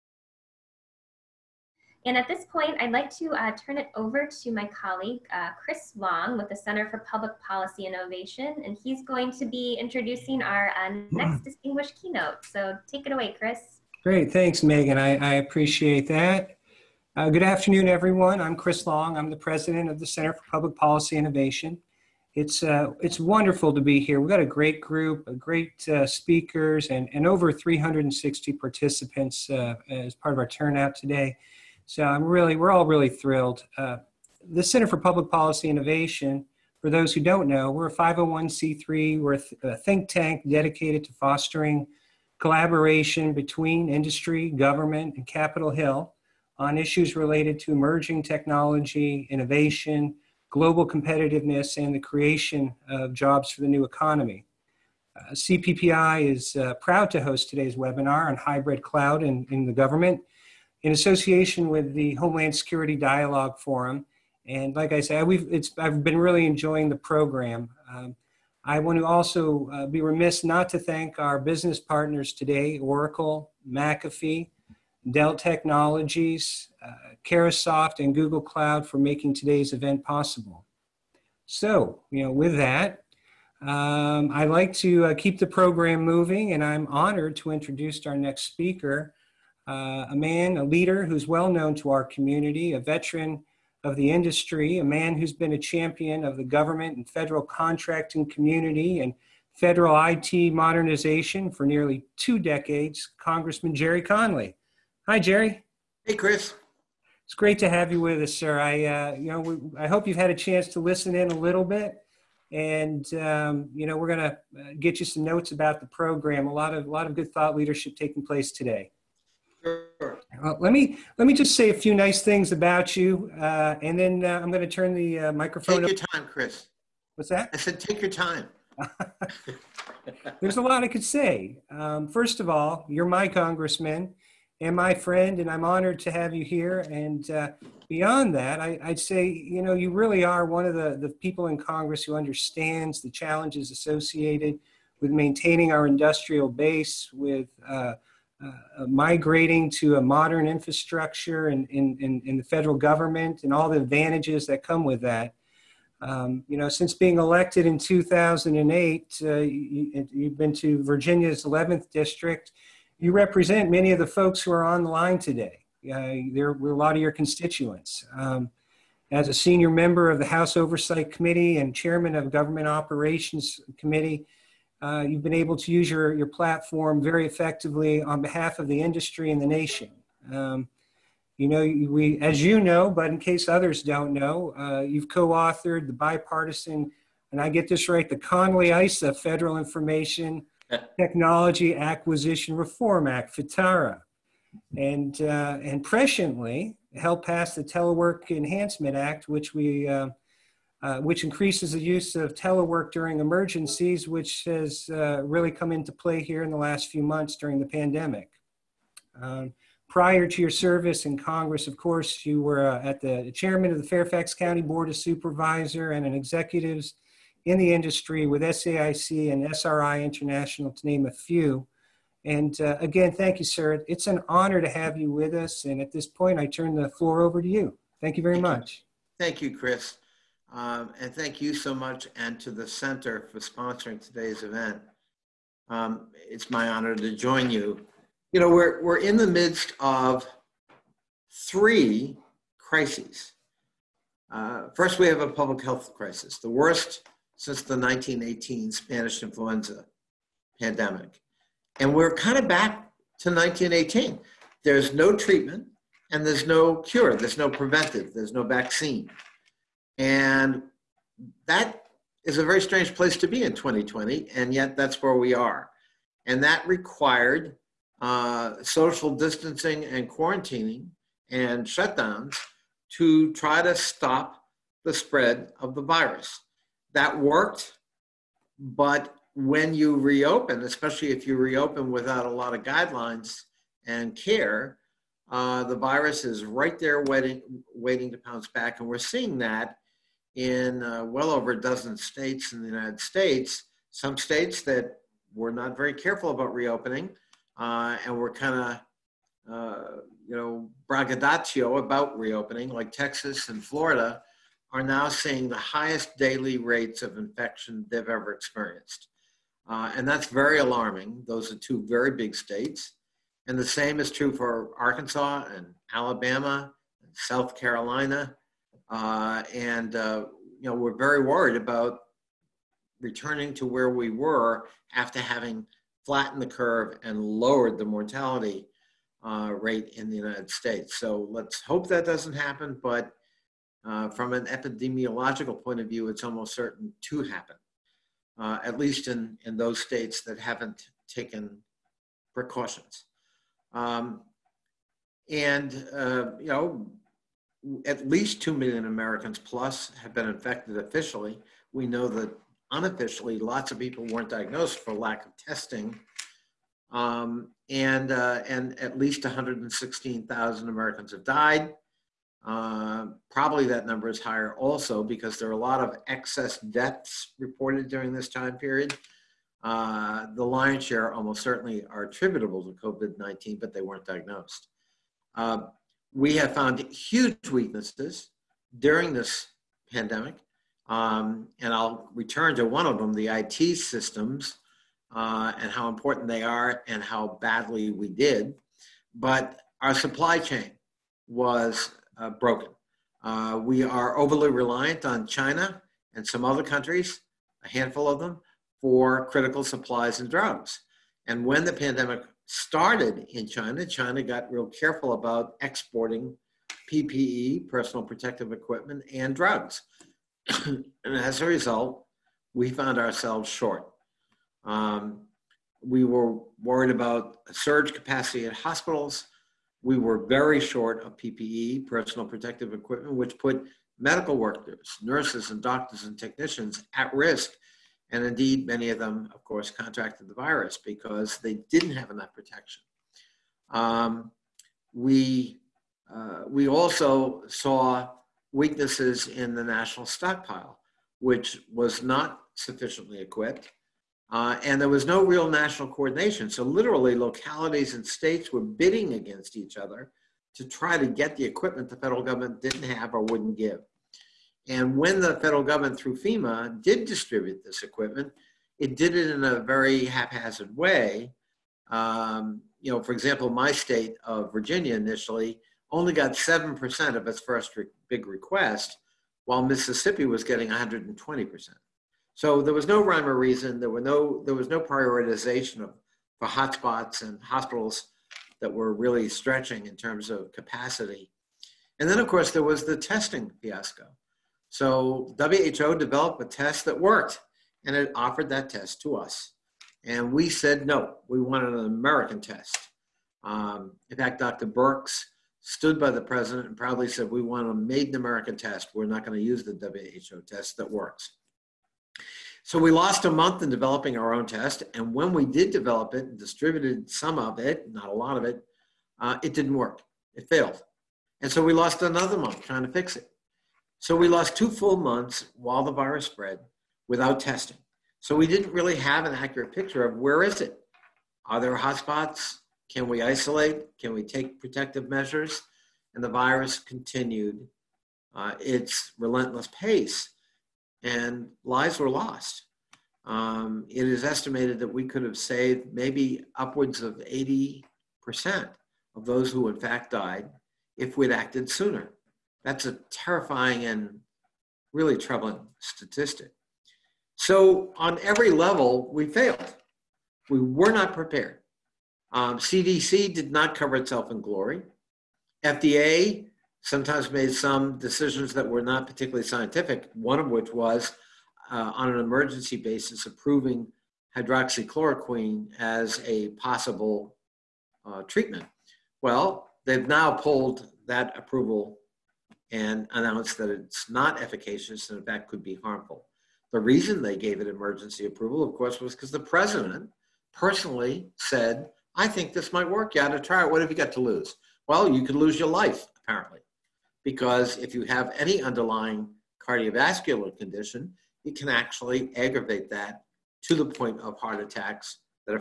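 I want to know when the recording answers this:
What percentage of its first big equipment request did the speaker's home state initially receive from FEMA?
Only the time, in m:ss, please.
7:46.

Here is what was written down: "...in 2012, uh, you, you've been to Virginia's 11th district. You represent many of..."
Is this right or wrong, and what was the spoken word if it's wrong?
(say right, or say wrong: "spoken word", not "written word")
wrong: "2008", not "2012".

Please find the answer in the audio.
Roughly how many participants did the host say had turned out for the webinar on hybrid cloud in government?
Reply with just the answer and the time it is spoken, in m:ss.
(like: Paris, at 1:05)
over 360, at 0:27.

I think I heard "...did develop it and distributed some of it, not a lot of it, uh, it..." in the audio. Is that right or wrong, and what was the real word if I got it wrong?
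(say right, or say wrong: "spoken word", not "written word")
right.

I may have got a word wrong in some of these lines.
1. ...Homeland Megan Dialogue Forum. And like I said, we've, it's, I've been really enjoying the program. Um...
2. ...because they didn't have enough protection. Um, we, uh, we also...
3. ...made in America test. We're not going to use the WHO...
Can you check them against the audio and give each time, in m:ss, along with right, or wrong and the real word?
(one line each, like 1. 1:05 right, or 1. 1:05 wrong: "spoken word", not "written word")
1. 1:02 wrong: "Security", not "Megan"
2. 7:10 right
3. 8:17 right.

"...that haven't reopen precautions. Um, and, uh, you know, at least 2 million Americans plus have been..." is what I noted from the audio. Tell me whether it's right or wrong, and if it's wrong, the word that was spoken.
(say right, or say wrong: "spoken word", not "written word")
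wrong: "taken", not "reopen".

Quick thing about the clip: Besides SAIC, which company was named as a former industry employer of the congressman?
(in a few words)
SRI International.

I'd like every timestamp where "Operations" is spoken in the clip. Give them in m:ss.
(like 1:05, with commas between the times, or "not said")
2:52.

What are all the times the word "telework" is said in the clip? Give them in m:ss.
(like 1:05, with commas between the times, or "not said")
3:17, 3:22.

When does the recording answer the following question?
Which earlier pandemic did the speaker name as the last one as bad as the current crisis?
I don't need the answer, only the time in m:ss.
4:07.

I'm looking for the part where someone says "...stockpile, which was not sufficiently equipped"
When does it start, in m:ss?
7:20.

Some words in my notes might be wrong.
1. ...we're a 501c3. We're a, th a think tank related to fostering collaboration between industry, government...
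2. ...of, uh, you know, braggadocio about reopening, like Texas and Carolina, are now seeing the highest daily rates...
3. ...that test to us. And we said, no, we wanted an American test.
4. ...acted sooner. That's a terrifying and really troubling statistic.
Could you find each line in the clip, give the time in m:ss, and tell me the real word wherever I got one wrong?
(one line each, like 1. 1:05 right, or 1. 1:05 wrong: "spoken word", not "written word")
1. 0:37 wrong: "dedicated", not "related"
2. 4:58 wrong: "Florida", not "Carolina"
3. 8:08 right
4. 9:01 right.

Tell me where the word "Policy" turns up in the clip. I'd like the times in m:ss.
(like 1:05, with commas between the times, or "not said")
0:07, 0:20, 0:35.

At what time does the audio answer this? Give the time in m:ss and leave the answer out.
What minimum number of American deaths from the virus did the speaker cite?
5:59.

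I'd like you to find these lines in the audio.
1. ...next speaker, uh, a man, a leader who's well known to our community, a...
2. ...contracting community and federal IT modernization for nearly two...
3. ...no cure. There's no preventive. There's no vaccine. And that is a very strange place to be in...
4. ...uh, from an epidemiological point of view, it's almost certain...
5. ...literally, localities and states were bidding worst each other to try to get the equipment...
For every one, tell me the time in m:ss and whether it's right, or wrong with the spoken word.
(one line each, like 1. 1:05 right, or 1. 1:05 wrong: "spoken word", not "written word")
1. 1:28 right
2. 1:37 right
3. 4:16 right
4. 5:33 right
5. 7:26 wrong: "against", not "worst".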